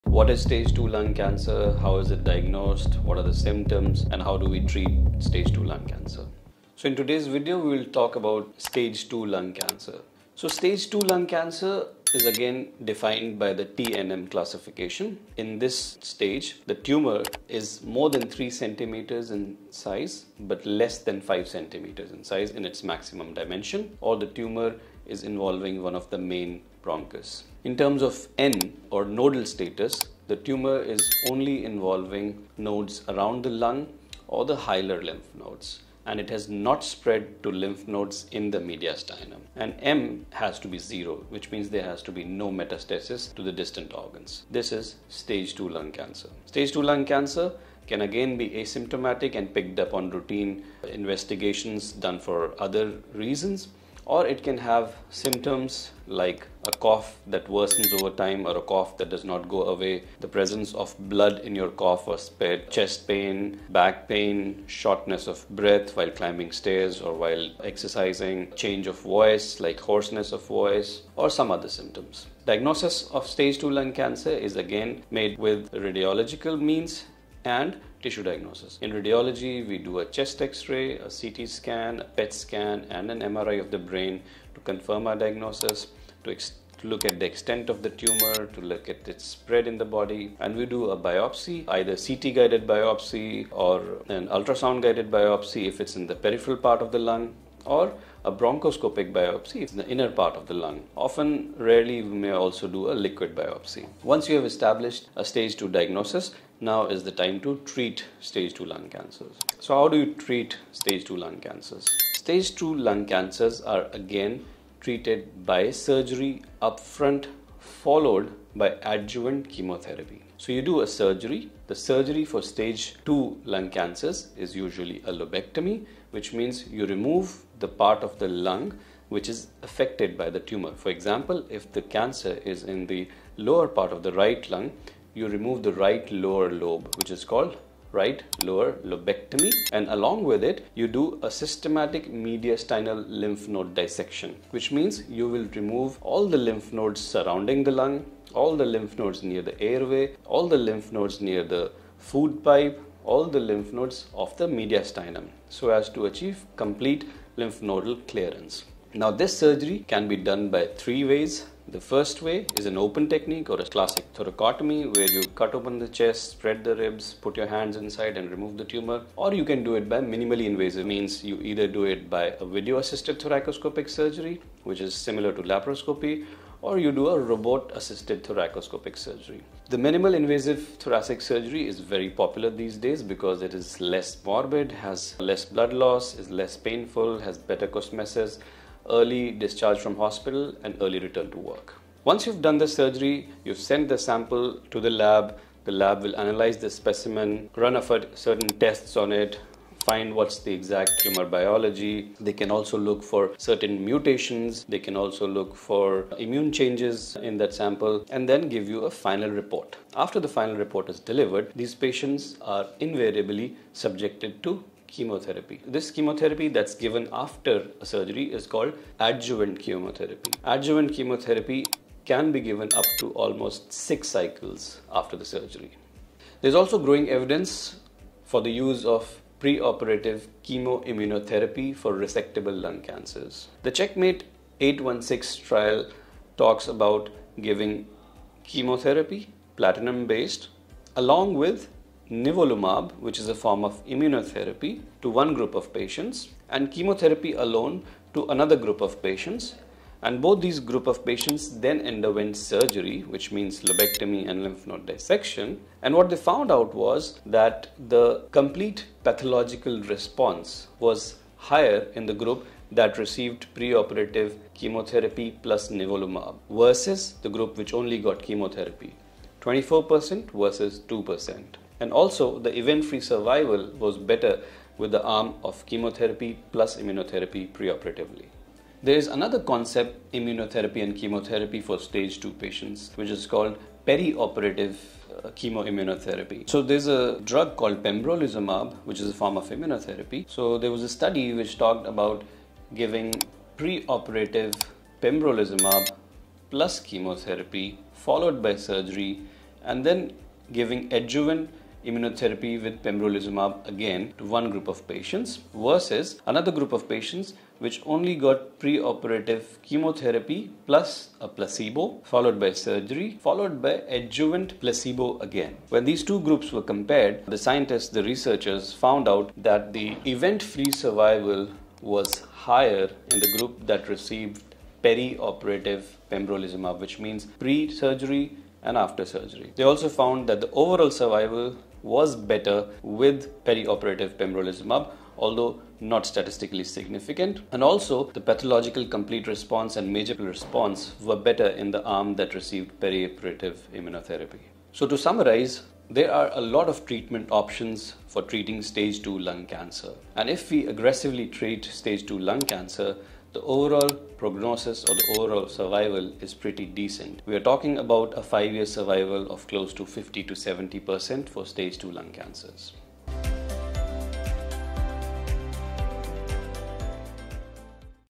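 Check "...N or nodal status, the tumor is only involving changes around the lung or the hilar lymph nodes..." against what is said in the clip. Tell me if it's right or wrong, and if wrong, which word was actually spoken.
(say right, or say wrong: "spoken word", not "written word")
wrong: "nodes", not "changes".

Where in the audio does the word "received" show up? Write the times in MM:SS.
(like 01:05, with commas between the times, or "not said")
04:22, 05:23, 05:42.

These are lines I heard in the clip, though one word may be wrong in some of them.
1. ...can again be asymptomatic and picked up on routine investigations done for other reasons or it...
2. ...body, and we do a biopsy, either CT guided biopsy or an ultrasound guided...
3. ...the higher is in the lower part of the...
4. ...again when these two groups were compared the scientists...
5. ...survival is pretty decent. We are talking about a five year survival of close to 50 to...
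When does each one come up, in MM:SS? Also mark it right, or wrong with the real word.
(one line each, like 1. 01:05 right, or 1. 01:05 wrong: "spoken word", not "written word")
1. 00:47 right
2. 01:29 right
3. 02:11 wrong: "cancer", not "higher"
4. 05:15 right
5. 05:55 right.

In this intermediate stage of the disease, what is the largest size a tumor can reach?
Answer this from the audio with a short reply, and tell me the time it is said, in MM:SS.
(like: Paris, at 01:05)
5 centimeters, at 00:20.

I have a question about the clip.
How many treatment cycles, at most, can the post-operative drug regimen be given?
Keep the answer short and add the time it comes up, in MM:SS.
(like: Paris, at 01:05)
6, at 03:43.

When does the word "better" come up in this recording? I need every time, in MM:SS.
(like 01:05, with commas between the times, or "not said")
03:07, 04:33, 05:32, 05:41.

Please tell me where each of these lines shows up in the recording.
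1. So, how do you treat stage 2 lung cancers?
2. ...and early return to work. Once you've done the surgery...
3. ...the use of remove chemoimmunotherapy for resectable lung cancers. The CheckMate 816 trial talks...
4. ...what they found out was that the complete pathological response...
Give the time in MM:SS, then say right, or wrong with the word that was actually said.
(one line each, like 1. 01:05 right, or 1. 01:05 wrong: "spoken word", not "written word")
1. 01:49 right
2. 03:10 right
3. 03:48 wrong: "preoperative", not "remove"
4. 04:15 right.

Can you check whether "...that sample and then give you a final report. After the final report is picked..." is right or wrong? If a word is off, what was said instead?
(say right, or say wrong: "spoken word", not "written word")
wrong: "delivered", not "picked".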